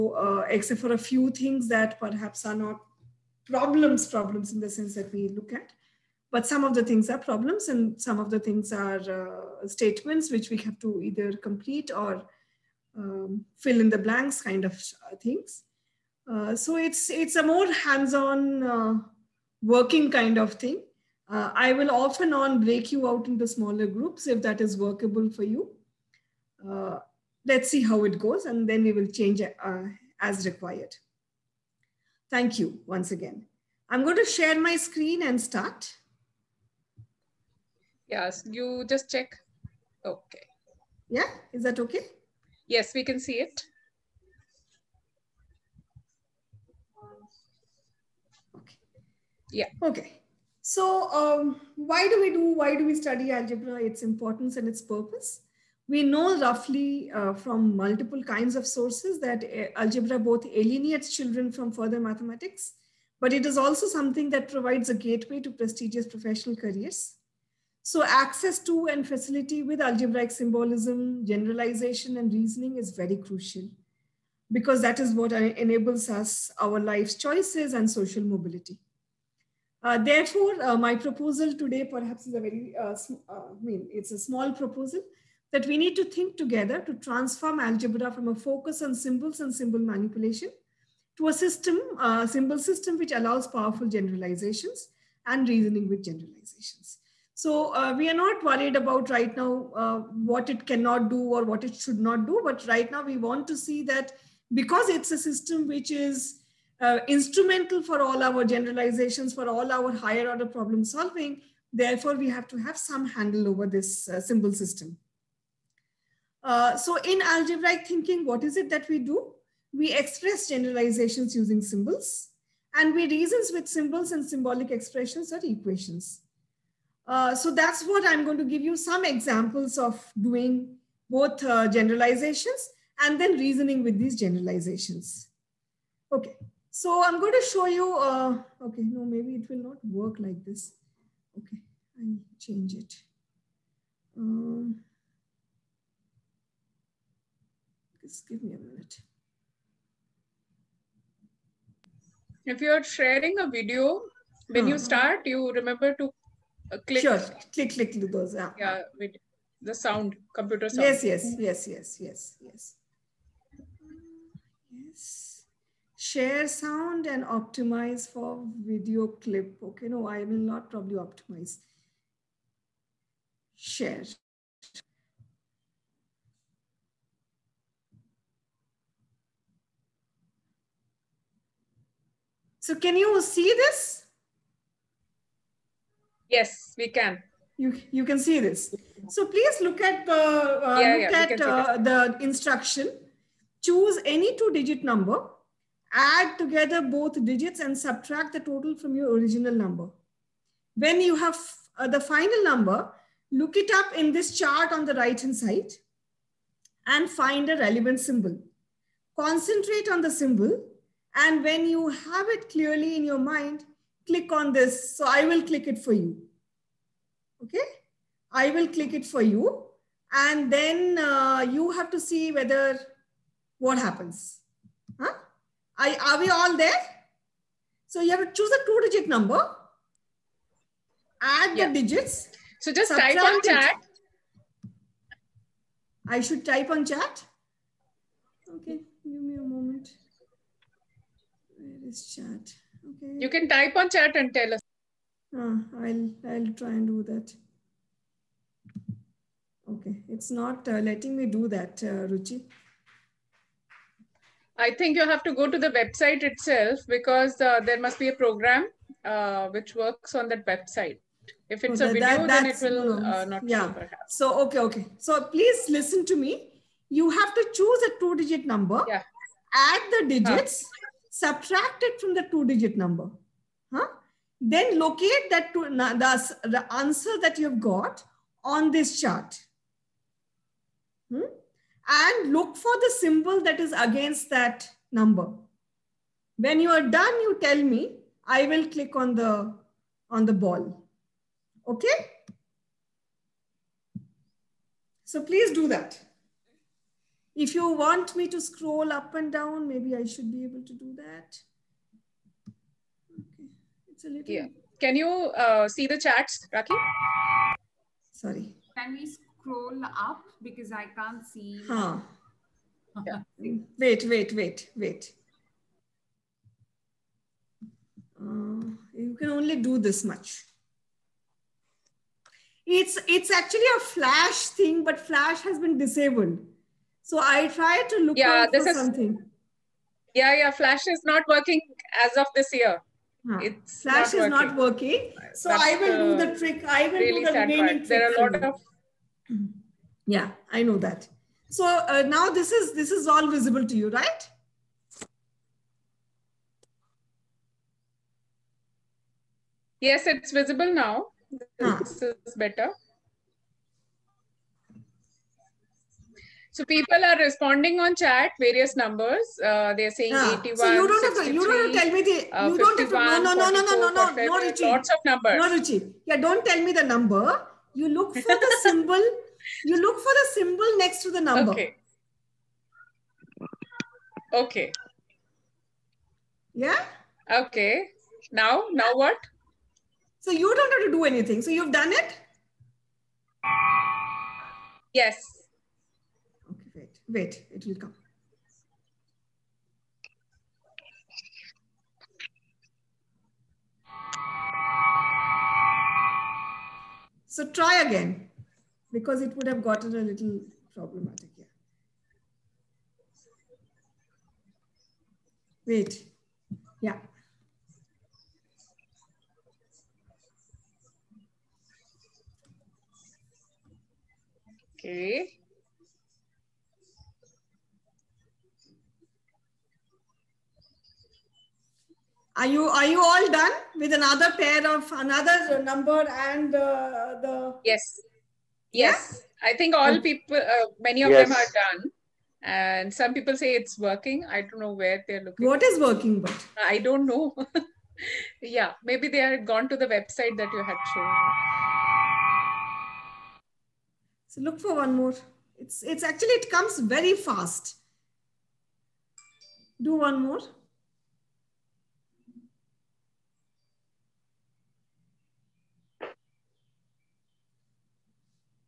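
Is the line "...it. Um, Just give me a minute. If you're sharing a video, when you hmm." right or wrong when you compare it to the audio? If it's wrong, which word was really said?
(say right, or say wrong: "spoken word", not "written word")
right.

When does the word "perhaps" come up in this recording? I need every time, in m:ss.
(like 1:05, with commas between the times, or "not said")
0:01, 1:21.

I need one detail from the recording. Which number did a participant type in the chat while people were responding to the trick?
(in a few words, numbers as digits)
81.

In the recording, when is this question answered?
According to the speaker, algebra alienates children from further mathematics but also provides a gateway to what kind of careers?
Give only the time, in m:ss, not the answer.
1:05.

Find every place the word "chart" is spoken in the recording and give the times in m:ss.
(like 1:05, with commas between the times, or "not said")
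3:24, 4:38.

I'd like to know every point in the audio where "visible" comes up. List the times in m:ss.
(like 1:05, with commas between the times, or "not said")
5:43, 5:50.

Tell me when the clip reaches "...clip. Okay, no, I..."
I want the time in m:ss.
2:49.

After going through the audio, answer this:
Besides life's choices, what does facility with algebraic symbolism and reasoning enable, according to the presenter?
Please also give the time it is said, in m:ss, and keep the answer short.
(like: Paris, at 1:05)
social mobility, at 1:17.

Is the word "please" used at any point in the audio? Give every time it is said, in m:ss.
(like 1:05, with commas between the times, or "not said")
3:09, 4:25, 4:55.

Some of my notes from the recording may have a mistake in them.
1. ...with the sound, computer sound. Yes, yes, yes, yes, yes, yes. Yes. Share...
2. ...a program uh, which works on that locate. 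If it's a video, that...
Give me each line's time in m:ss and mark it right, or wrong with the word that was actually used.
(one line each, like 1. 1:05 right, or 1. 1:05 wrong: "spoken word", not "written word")
1. 2:38 right
2. 4:18 wrong: "website", not "locate".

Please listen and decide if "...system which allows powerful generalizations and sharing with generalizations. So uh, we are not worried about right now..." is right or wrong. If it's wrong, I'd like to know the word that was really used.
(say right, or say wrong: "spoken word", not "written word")
wrong: "reasoning", not "sharing".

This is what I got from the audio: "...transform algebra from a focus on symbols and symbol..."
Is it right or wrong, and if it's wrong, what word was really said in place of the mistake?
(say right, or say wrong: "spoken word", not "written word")
right.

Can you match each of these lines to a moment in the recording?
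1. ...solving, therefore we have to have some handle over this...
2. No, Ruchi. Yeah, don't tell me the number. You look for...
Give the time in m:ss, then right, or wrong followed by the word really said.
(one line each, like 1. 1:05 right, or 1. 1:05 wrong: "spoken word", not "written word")
1. 1:50 right
2. 6:05 right.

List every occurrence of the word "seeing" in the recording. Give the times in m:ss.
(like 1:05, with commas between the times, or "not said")
not said.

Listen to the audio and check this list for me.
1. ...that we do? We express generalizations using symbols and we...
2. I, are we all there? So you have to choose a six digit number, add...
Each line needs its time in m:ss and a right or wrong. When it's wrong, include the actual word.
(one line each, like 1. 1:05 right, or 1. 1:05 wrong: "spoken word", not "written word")
1. 1:58 right
2. 3:45 wrong: "two", not "six".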